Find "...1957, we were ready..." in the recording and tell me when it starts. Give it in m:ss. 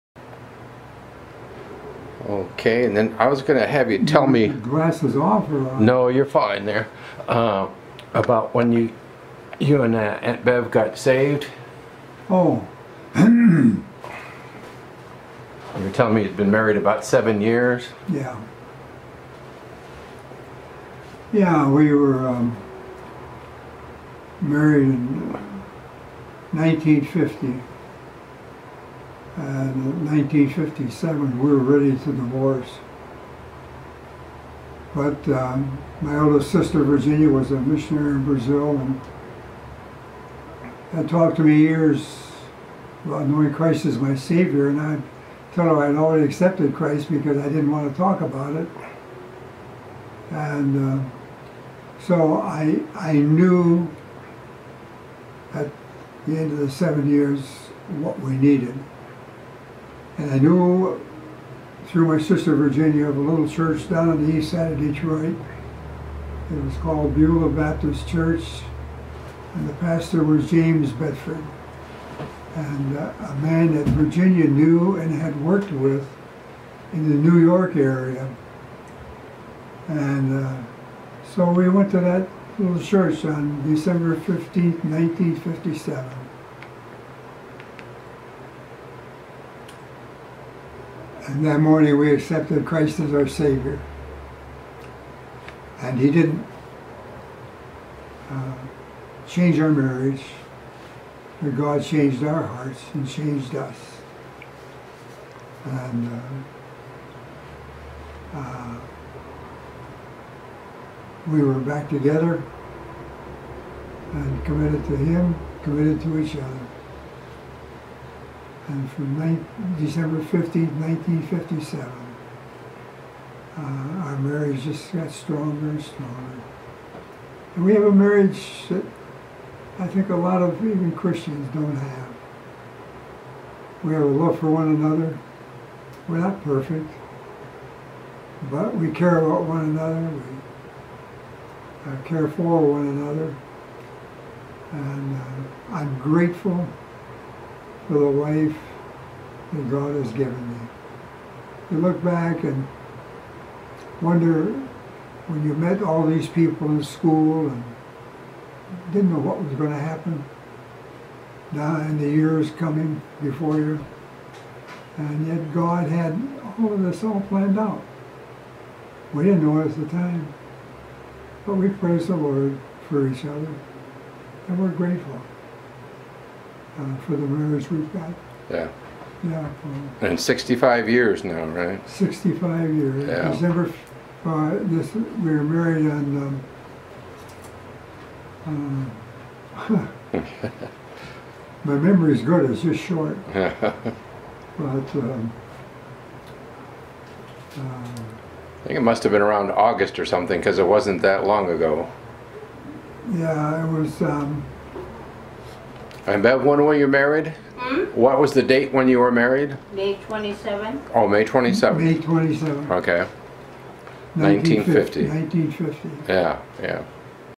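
0:30.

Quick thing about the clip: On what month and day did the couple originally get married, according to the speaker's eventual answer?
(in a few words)
May 27.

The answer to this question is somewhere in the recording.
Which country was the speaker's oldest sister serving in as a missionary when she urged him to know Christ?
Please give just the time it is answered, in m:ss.
0:38.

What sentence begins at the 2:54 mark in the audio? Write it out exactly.
And we're grateful uh, for the marriage we've got.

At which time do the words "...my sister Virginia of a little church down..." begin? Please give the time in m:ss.
1:02.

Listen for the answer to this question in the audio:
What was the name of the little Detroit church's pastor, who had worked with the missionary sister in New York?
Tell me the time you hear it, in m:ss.
1:10.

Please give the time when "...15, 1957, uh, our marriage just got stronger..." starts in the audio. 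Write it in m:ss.
2:00.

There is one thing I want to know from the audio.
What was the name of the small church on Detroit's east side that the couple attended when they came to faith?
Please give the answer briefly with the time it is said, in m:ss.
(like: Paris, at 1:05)
Beulah Baptist Church, at 1:07.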